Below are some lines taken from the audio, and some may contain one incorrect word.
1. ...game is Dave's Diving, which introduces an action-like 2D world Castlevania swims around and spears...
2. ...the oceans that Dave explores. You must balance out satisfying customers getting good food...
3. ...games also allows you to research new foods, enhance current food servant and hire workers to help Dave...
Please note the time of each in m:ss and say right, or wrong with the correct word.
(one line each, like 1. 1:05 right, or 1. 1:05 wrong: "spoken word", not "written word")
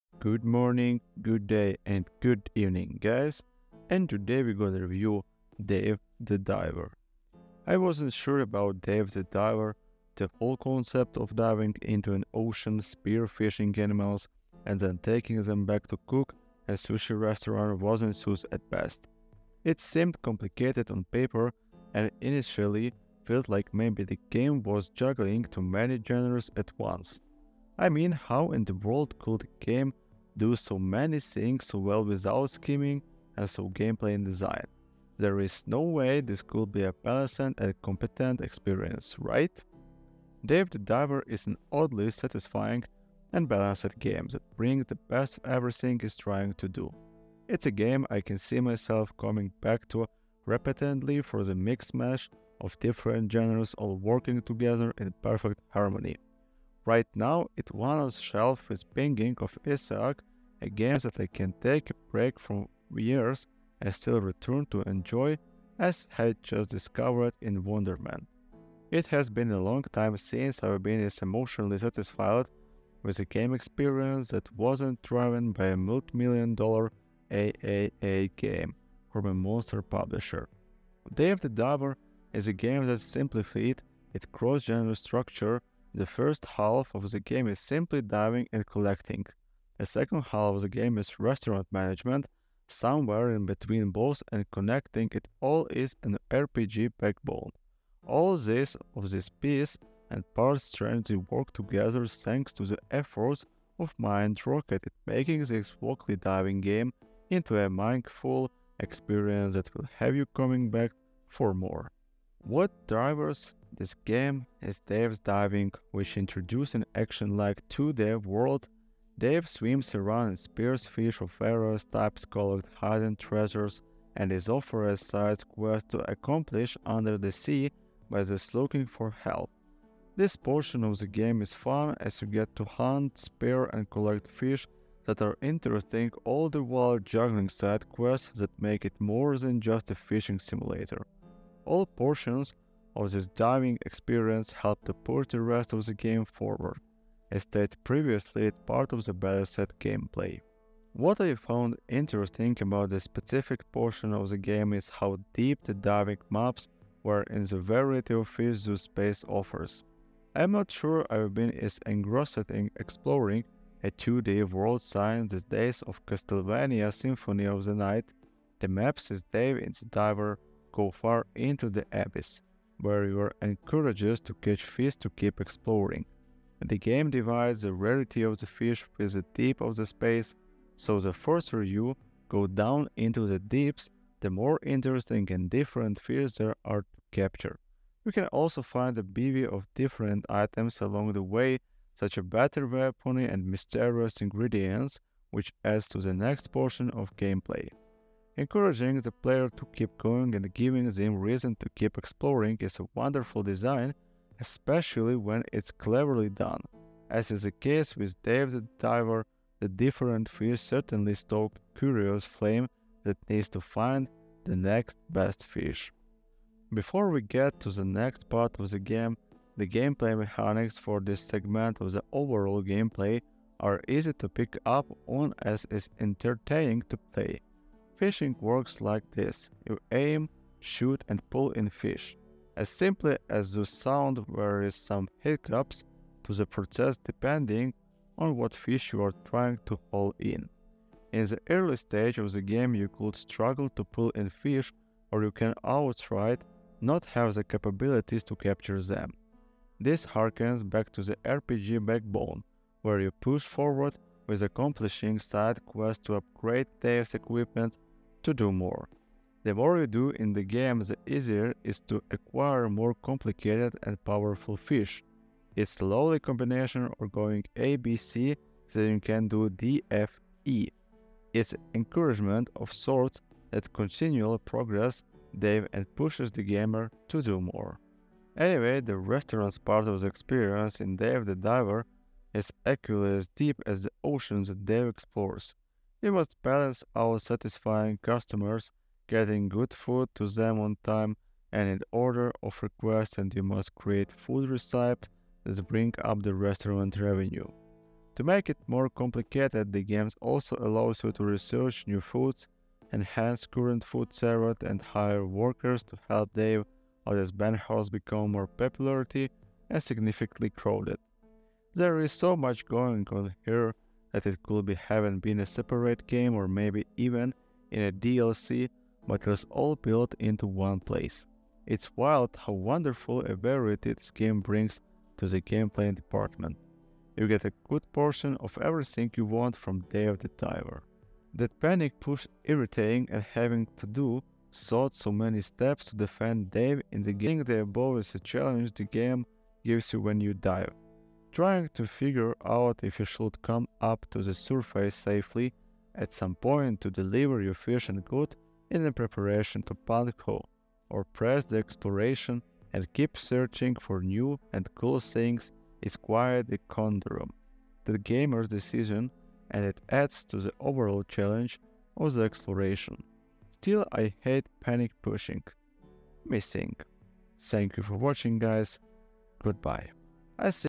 1. 1:53 wrong: "Dave", not "Castlevania"
2. 4:43 right
3. 4:59 right.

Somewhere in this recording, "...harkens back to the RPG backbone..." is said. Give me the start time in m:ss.
4:10.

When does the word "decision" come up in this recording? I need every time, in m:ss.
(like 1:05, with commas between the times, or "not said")
5:58.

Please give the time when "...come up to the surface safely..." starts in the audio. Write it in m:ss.
5:43.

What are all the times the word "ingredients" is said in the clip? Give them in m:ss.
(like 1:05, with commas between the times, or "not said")
3:14.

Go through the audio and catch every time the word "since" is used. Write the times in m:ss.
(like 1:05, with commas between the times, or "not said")
1:10, 2:44.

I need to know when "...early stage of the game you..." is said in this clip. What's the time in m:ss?
4:01.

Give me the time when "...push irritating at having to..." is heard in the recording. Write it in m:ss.
5:31.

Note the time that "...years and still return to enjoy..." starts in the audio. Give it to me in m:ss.
1:02.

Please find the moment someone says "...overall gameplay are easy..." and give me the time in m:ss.
3:42.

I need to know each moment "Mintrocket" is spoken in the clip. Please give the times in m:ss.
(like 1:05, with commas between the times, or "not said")
1:43.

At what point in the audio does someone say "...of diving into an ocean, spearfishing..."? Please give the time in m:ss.
0:11.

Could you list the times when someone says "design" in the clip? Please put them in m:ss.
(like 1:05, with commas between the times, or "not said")
0:34, 3:23.